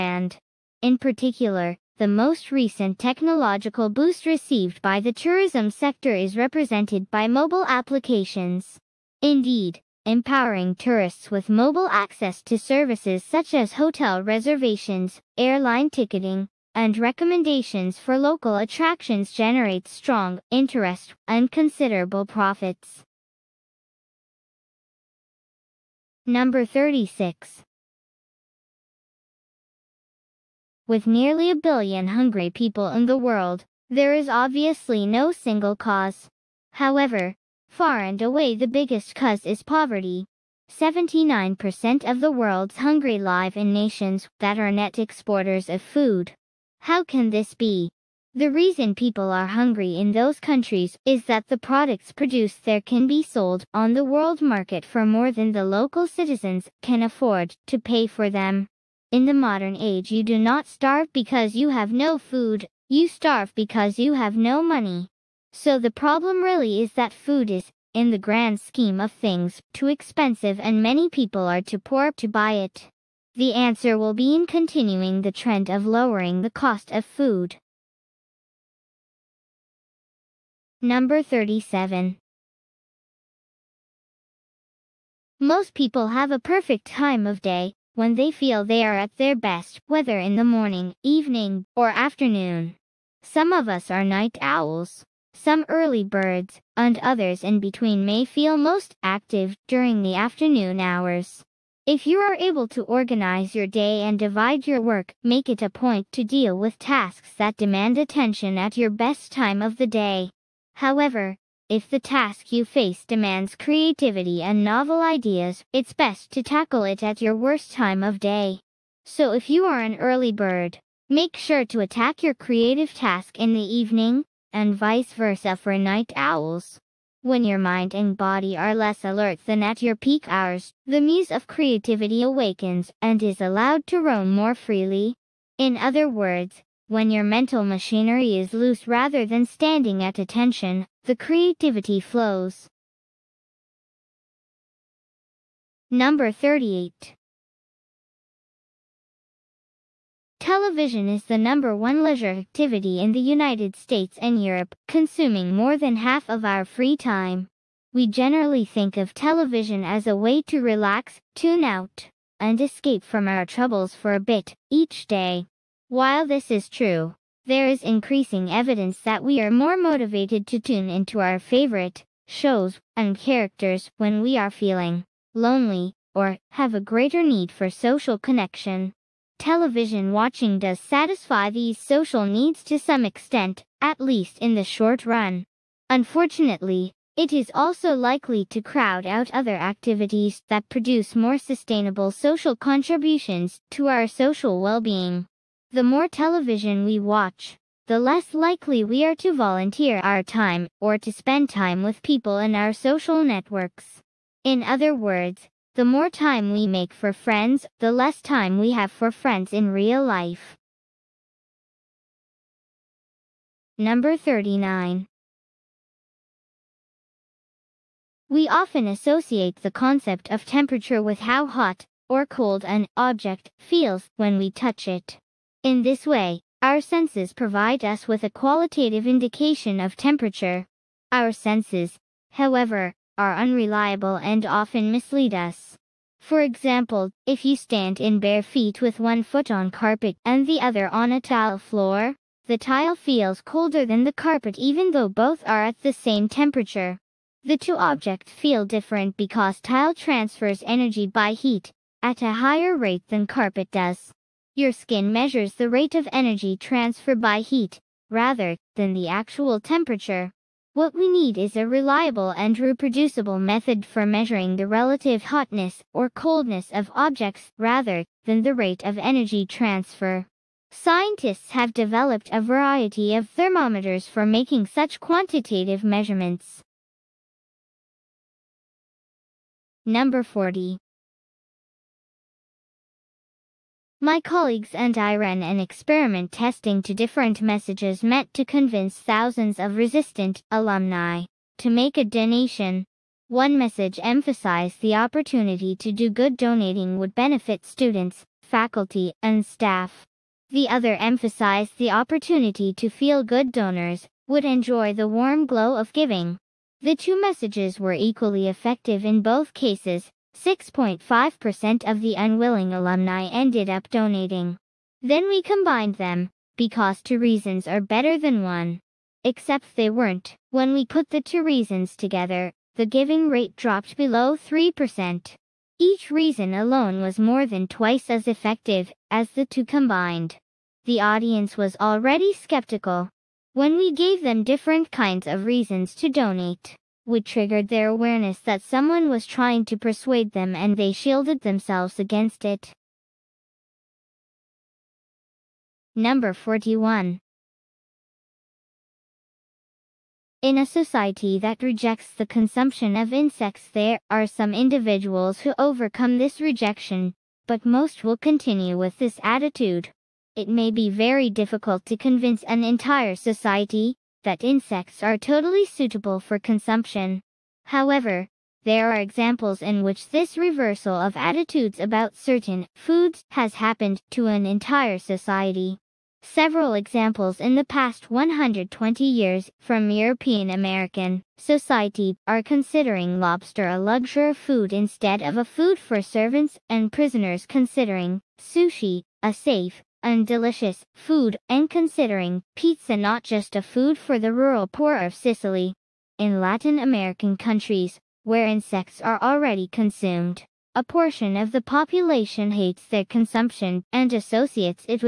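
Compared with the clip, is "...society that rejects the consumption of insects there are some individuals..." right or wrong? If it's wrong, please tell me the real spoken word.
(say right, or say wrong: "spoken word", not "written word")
right.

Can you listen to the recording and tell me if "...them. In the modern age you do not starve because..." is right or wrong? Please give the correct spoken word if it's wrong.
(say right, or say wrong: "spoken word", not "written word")
right.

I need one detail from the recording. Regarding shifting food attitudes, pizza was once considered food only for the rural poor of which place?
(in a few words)
Sicily.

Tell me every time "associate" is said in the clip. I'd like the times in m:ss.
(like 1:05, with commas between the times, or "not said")
3:38, 6:44.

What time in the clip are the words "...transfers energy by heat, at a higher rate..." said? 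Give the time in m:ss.
4:09.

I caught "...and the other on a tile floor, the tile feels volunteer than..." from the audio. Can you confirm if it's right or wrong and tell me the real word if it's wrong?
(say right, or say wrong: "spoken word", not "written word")
wrong: "colder", not "volunteer".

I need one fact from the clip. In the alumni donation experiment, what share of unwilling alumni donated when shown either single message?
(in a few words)
6.5%.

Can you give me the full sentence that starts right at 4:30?
Scientists have developed a variety of thermometers for making such quantitative measurements.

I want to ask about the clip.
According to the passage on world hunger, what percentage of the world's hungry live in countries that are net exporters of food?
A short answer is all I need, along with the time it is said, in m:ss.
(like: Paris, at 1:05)
79%, at 0:40.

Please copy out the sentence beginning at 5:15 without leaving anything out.
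Then we combined them, because two reasons are better than one.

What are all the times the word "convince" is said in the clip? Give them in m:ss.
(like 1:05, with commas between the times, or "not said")
4:48, 6:01.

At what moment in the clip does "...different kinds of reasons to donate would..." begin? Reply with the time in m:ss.
5:34.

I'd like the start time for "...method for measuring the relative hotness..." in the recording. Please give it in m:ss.
4:23.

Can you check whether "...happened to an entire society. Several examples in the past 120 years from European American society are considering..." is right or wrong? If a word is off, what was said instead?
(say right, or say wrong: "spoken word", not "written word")
right.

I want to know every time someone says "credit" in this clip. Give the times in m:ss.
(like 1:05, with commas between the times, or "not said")
not said.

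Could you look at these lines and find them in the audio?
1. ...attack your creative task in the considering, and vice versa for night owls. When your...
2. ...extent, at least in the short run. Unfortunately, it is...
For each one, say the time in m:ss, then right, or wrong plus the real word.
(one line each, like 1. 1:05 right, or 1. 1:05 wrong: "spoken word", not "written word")
1. 2:01 wrong: "evening", not "considering"
2. 3:03 right.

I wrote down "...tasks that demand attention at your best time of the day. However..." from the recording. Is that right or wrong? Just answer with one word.
right.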